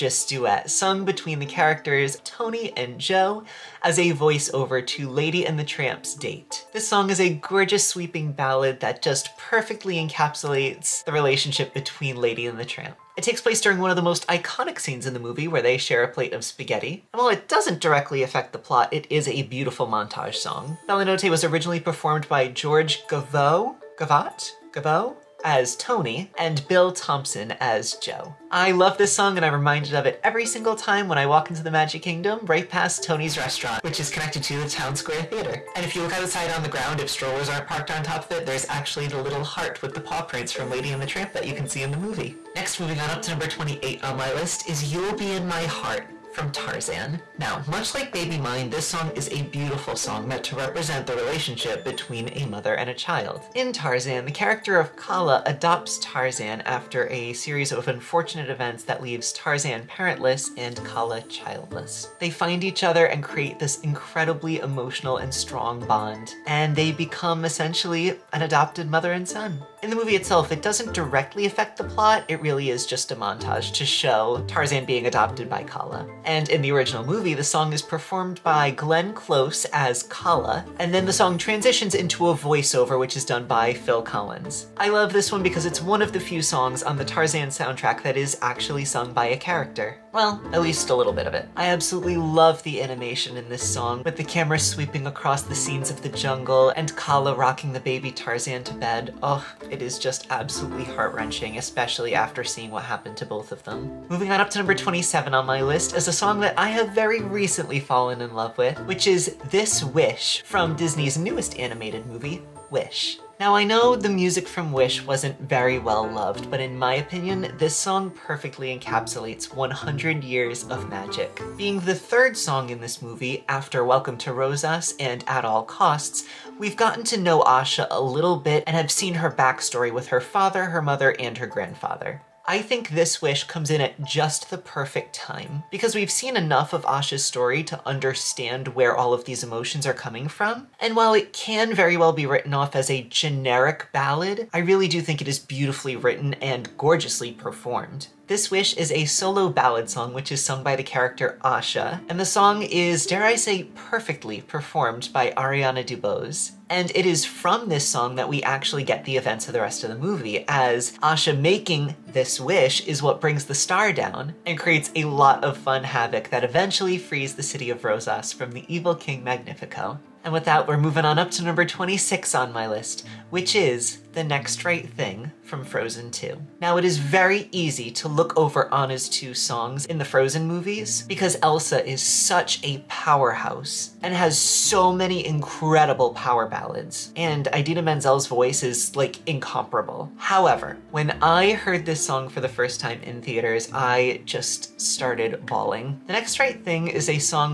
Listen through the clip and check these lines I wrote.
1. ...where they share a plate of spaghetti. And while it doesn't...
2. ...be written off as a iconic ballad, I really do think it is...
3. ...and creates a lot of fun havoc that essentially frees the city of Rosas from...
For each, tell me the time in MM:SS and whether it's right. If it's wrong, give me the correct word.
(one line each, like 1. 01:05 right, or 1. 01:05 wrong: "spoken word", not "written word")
1. 00:15 right
2. 02:22 wrong: "generic", not "iconic"
3. 02:44 wrong: "eventually", not "essentially".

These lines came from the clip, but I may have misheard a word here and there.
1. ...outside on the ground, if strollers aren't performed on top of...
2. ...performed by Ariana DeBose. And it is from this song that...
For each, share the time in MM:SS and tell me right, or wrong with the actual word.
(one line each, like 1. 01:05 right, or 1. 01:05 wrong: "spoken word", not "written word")
1. 00:36 wrong: "parked", not "performed"
2. 02:34 right.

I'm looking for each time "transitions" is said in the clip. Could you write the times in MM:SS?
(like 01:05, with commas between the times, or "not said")
01:21.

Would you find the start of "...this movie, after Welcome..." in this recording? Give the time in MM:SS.
02:02.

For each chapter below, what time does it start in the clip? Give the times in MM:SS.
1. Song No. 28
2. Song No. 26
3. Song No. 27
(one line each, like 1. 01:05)
1. 00:42
2. 02:49
3. 01:43.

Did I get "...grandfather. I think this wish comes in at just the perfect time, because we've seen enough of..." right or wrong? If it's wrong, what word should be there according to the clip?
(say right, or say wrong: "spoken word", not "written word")
right.